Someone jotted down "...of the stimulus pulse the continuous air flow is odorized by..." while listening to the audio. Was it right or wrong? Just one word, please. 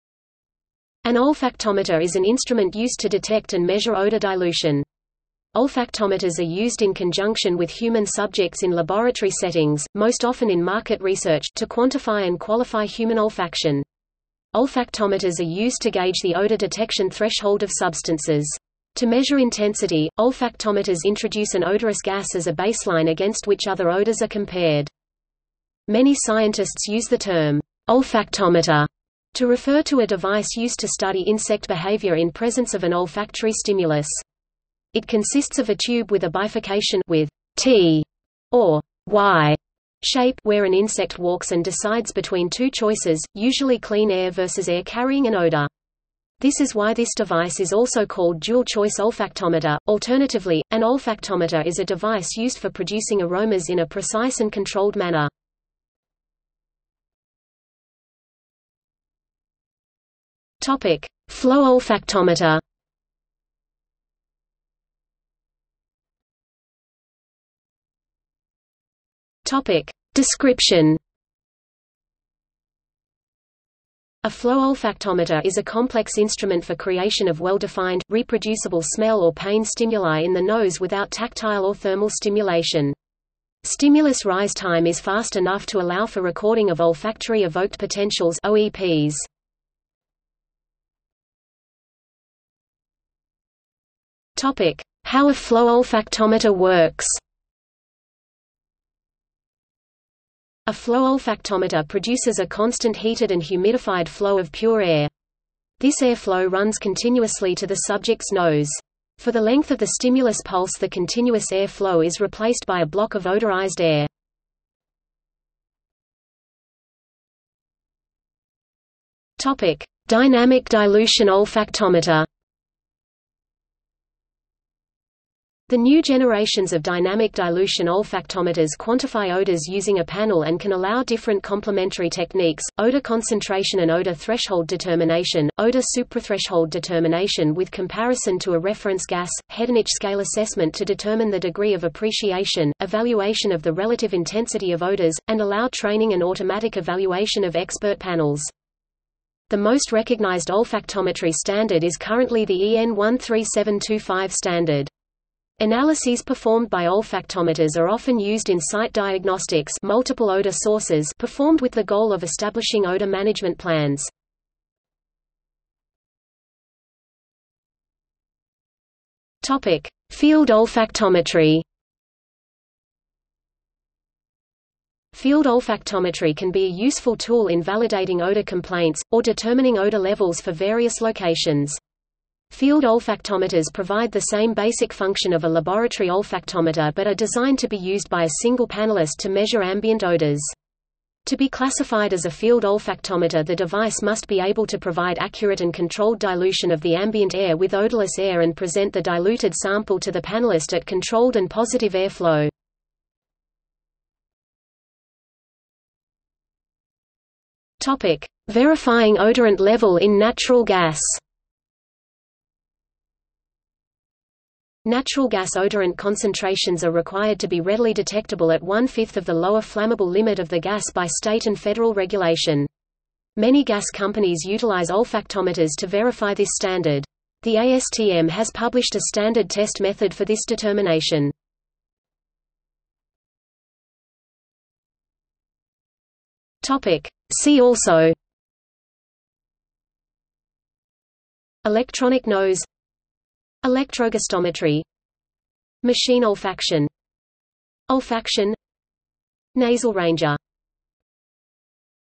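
wrong.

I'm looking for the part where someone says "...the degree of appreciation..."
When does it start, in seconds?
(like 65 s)
141 s.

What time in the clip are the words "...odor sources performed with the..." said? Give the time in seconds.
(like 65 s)
160 s.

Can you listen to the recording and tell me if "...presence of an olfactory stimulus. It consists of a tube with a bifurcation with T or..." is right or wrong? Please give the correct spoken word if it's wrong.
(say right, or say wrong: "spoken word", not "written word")
right.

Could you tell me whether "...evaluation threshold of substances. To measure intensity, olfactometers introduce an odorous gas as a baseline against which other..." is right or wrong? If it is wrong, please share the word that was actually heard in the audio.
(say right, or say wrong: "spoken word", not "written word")
wrong: "detection", not "evaluation".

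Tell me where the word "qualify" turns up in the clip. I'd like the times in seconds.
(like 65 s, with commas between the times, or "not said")
12 s.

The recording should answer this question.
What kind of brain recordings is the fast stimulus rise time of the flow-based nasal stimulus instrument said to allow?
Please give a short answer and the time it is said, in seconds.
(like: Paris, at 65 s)
olfactory evoked potentials, at 86 s.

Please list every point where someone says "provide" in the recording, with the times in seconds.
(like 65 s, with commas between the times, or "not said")
183 s, 194 s.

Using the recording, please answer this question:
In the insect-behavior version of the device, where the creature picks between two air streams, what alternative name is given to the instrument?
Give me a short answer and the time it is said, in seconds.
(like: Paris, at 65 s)
dual-choice olfactometer, at 48 s.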